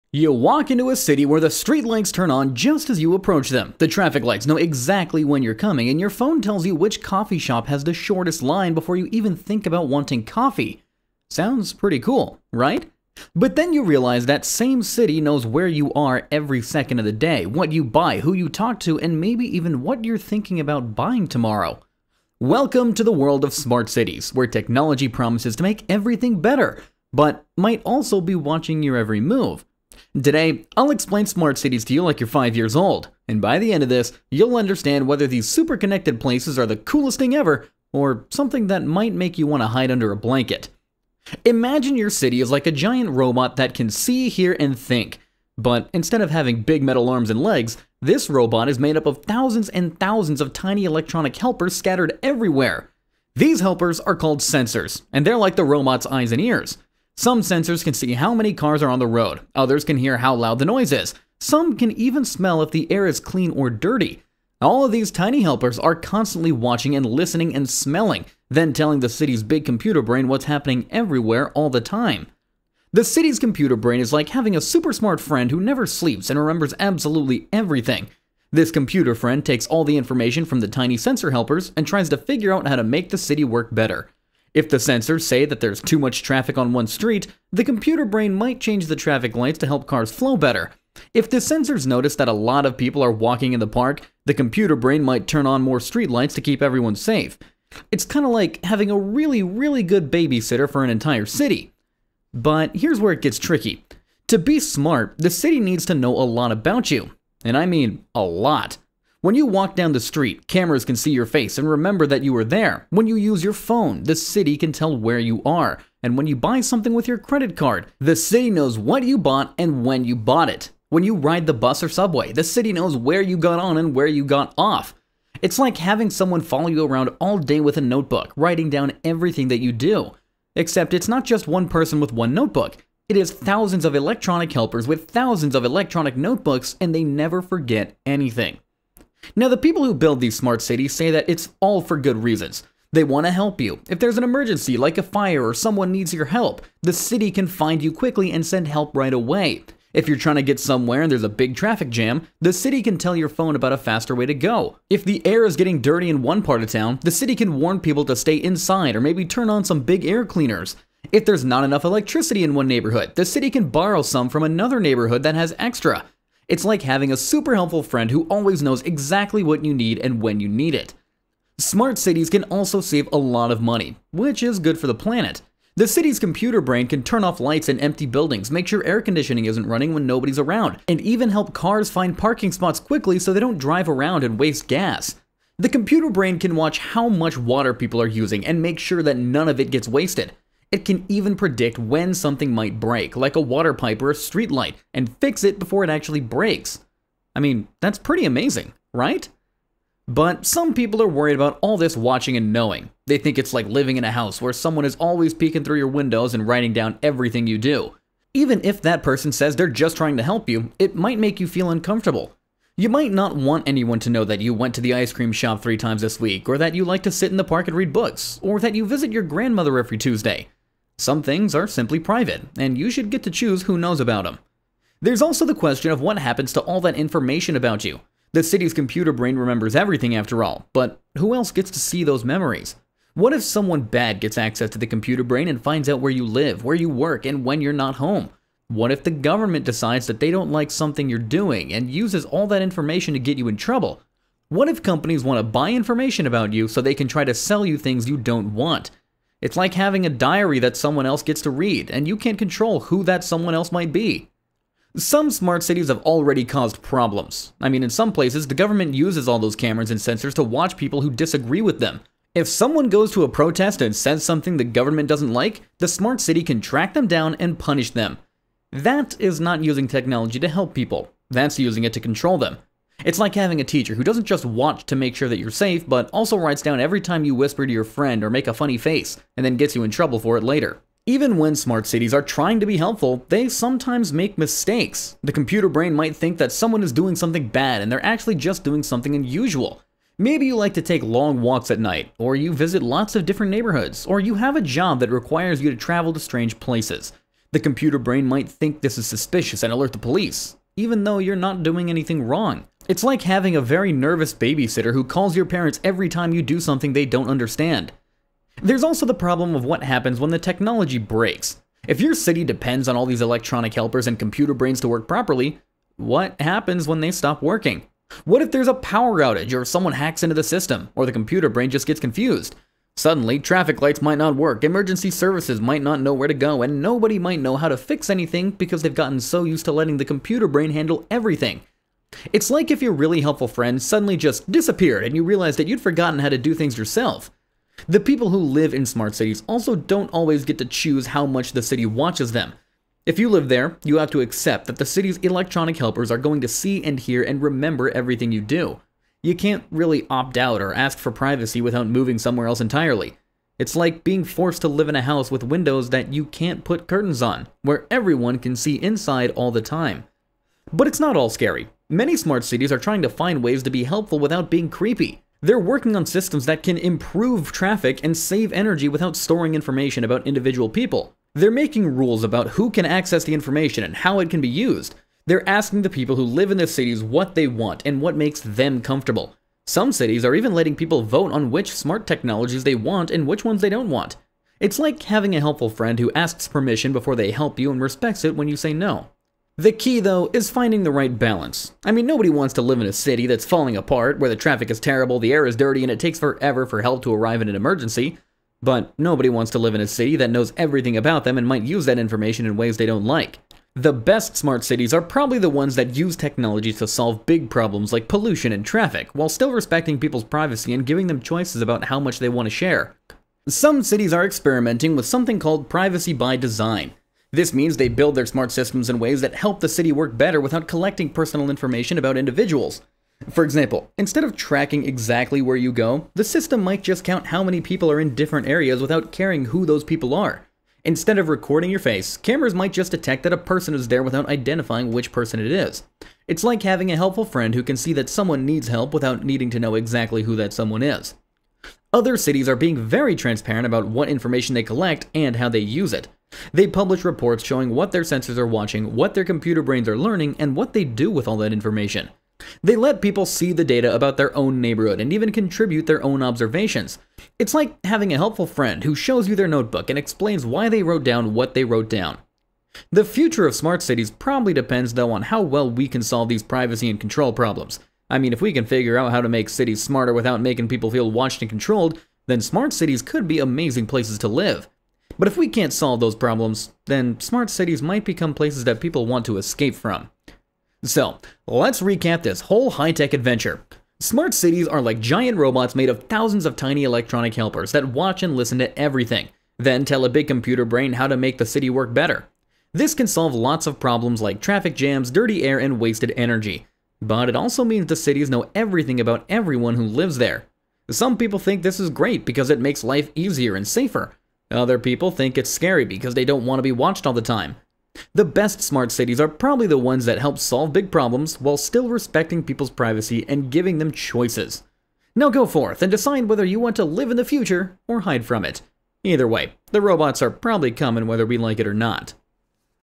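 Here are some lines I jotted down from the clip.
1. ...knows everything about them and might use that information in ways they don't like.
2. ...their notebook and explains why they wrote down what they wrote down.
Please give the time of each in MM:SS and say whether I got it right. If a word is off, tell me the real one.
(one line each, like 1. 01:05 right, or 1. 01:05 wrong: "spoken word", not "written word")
1. 06:40 right
2. 07:39 right.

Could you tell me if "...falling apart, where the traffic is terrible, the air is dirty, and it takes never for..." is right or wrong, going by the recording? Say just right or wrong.
wrong.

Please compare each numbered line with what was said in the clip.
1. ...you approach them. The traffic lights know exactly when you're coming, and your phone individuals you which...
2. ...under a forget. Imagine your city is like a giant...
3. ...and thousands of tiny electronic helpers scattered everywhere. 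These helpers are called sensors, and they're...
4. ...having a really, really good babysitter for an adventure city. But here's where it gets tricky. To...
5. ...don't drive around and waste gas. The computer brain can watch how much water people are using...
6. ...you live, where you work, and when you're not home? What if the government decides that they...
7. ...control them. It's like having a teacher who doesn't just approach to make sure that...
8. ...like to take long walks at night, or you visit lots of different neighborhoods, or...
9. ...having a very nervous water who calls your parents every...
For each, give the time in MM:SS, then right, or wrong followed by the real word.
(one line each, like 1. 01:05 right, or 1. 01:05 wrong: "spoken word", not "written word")
1. 00:02 wrong: "tells", not "individuals"
2. 00:39 wrong: "blanket", not "forget"
3. 00:49 right
4. 01:38 wrong: "entire", not "adventure"
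5. 03:03 right
6. 03:56 right
7. 04:31 wrong: "watch", not "approach"
8. 04:50 right
9. 05:03 wrong: "babysitter", not "water".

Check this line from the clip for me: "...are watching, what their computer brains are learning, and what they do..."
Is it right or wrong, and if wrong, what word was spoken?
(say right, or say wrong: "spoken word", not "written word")
right.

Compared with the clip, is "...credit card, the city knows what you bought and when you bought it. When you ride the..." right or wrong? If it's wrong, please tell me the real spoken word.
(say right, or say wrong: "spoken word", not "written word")
right.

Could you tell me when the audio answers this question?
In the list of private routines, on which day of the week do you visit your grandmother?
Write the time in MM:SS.
03:39.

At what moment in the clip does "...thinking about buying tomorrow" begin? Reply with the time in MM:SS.
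00:20.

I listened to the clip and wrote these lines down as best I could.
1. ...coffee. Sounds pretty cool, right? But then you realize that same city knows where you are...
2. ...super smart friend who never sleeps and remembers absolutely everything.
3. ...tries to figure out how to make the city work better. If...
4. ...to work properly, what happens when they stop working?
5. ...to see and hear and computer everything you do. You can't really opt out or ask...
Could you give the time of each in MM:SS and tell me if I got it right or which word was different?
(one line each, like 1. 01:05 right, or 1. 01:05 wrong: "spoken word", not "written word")
1. 00:10 right
2. 01:14 right
3. 01:21 right
4. 05:14 right
5. 05:46 wrong: "remember", not "computer".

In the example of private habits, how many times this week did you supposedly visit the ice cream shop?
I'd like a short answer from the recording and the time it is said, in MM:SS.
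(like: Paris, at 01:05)
3, at 03:35.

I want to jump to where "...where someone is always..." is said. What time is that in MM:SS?
03:24.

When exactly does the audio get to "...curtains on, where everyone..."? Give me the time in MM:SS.
05:56.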